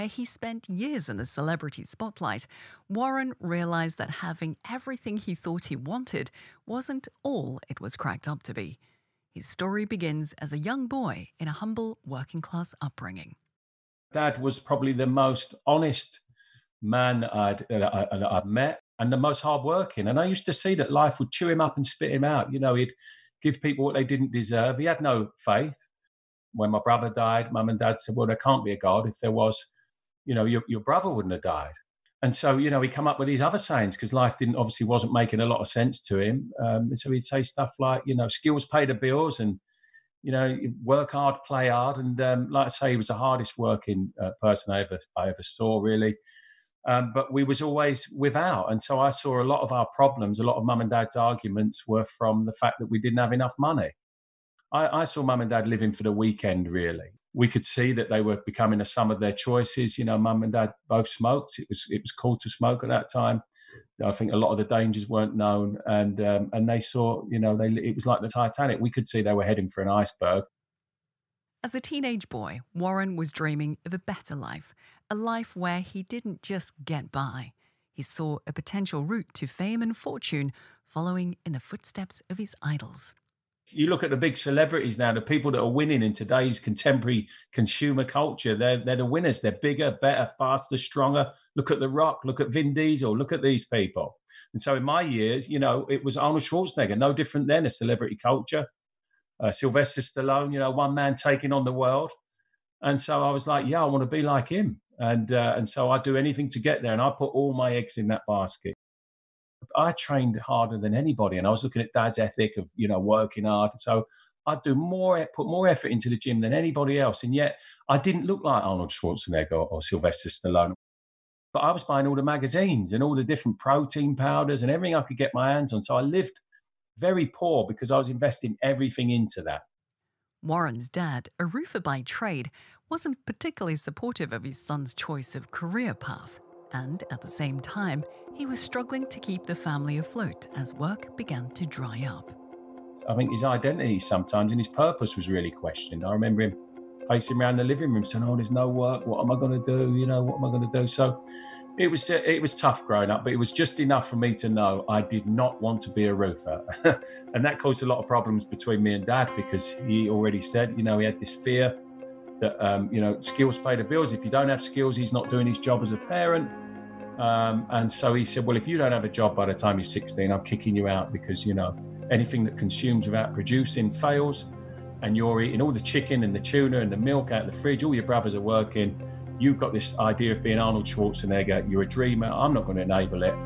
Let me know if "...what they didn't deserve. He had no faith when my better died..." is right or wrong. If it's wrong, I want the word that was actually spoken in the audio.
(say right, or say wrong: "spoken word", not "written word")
wrong: "brother", not "better".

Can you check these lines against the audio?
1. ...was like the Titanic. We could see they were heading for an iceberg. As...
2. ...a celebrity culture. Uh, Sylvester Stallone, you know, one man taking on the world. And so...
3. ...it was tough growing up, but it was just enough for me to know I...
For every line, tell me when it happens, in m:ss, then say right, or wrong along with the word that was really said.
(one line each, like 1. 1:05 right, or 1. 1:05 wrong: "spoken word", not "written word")
1. 1:07 right
2. 1:37 right
3. 2:32 right.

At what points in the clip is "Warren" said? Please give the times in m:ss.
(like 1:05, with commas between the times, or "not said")
0:02, 1:12, 2:10.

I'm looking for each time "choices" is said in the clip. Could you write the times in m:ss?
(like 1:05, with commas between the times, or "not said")
0:59, 2:14.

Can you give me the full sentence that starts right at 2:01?
But I was buying all the magazines and all the different protein powders and everything I could get my hands on.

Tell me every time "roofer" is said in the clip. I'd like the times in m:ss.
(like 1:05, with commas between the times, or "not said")
2:11, 2:36.